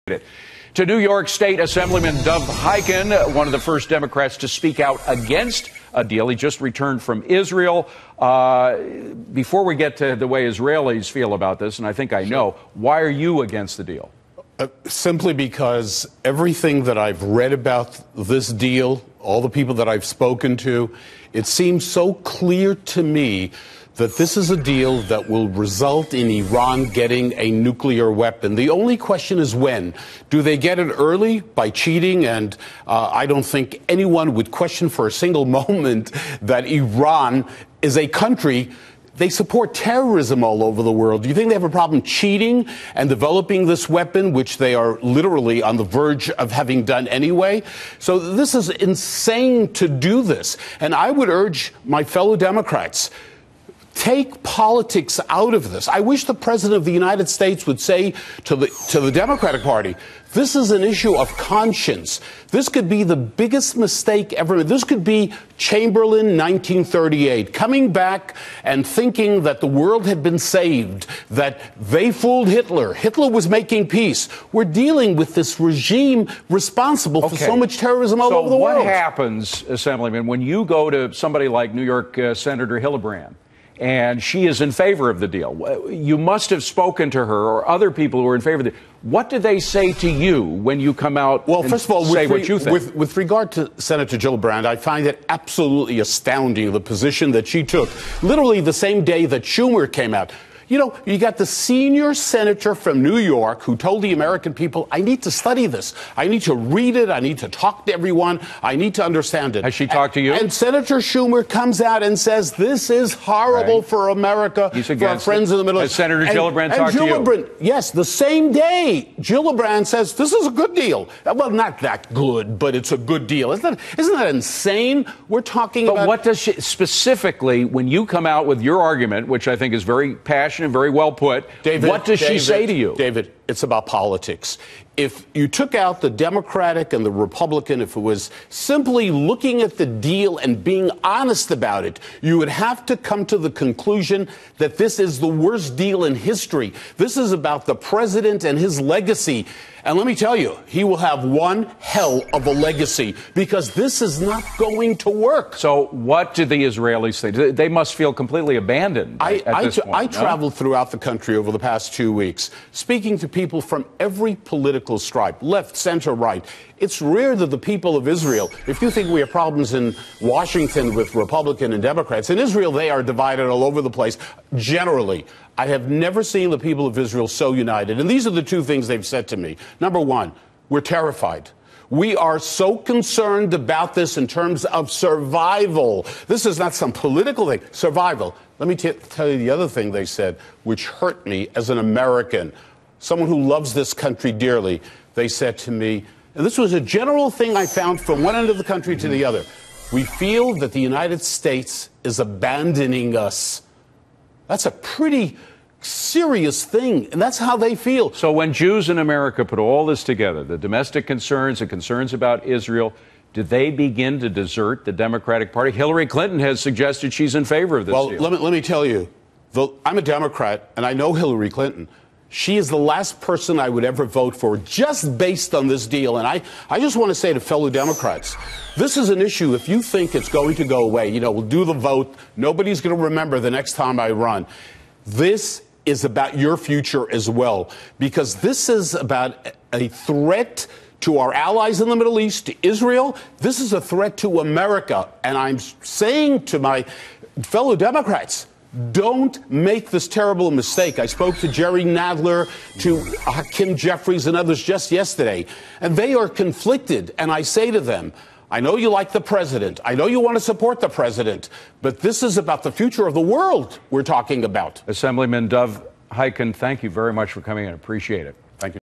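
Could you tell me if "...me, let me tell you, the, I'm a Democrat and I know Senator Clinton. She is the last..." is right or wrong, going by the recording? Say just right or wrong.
wrong.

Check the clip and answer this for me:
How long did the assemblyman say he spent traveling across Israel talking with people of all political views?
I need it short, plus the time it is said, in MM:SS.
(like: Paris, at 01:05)
2 weeks, at 02:41.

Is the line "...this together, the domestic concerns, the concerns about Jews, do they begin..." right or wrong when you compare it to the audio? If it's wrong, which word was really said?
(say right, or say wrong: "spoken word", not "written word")
wrong: "Israel", not "Jews".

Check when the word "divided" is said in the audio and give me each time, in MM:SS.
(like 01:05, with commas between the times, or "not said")
02:53.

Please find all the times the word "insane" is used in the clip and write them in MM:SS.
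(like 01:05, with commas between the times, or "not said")
00:48, 02:04.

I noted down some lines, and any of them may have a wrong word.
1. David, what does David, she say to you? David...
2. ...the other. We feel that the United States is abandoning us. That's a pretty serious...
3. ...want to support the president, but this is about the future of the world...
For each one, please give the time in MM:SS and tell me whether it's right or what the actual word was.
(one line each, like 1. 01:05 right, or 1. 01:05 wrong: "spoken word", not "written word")
1. 02:11 right
2. 03:19 right
3. 04:20 right.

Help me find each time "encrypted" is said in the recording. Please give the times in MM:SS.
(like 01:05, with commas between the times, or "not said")
not said.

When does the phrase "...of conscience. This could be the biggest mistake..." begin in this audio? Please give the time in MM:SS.
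01:01.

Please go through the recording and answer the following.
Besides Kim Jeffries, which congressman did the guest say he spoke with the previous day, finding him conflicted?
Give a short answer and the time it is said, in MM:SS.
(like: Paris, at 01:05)
Jerry Nadler, at 04:11.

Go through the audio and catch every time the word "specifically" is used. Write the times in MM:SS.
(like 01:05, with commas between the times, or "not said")
02:06.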